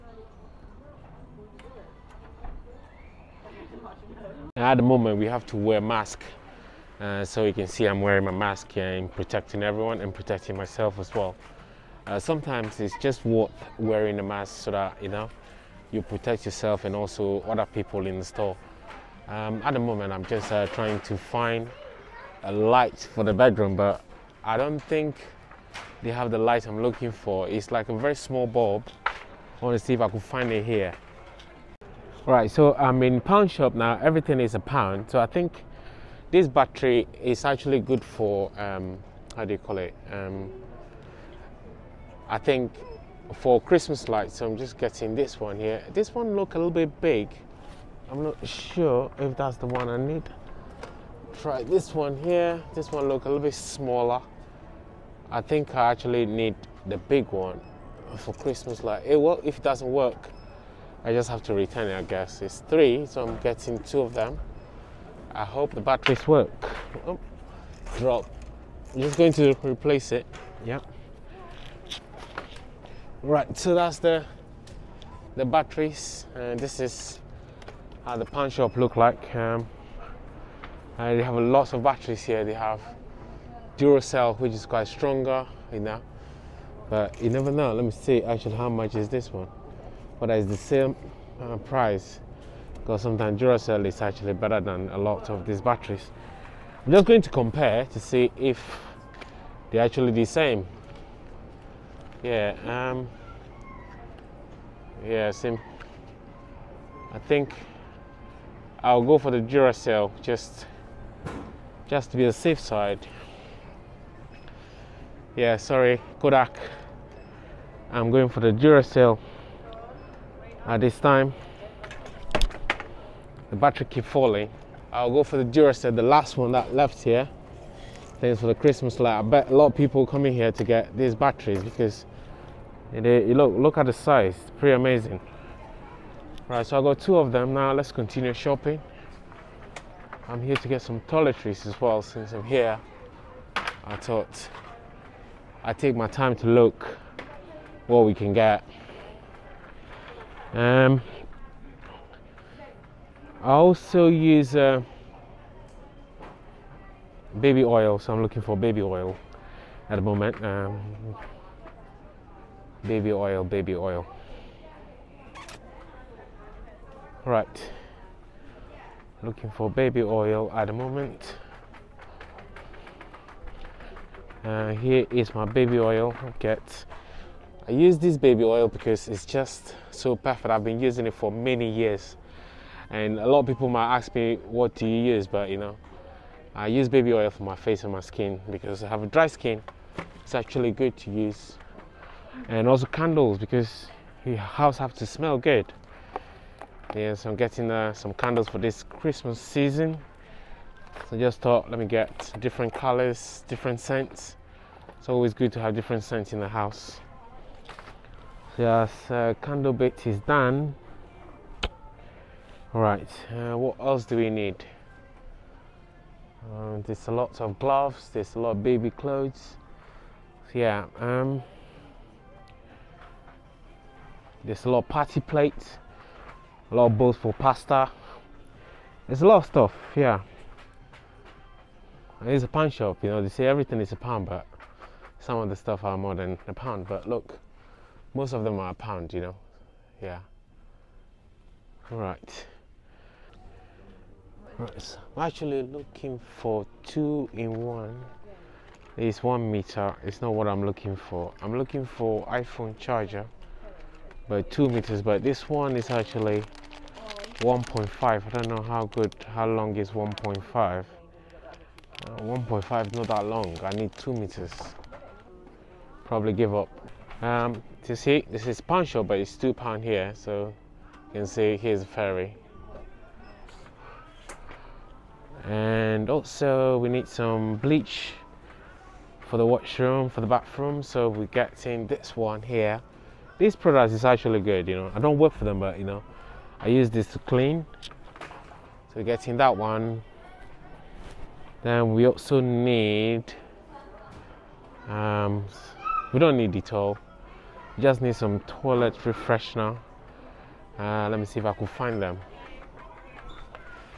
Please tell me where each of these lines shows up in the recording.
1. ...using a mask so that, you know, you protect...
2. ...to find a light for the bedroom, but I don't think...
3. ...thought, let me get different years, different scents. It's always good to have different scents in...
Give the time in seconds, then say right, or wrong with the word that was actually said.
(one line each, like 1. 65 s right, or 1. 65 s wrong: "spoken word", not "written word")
1. 13 s wrong: "wearing", not "using"
2. 20 s right
3. 201 s wrong: "colors", not "years".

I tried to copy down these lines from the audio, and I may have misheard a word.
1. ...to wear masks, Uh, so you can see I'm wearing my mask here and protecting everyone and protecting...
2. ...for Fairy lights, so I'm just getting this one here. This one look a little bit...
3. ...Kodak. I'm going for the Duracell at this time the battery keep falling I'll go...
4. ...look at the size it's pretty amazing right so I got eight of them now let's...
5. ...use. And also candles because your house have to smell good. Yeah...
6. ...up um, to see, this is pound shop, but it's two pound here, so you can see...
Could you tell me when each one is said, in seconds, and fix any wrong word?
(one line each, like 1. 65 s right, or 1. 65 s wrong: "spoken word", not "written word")
1. 5 s right
2. 43 s wrong: "Christmas", not "Fairy"
3. 116 s right
4. 133 s wrong: "two", not "eight"
5. 191 s right
6. 266 s right.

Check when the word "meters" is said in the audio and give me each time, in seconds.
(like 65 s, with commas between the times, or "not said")
249 s, 254 s, 264 s.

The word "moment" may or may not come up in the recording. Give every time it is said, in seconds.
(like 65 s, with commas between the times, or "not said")
4 s, 19 s, 160 s, 170 s.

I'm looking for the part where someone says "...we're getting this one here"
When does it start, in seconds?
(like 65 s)
281 s.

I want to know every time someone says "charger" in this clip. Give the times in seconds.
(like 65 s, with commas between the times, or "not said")
252 s.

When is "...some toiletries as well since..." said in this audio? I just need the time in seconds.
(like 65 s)
140 s.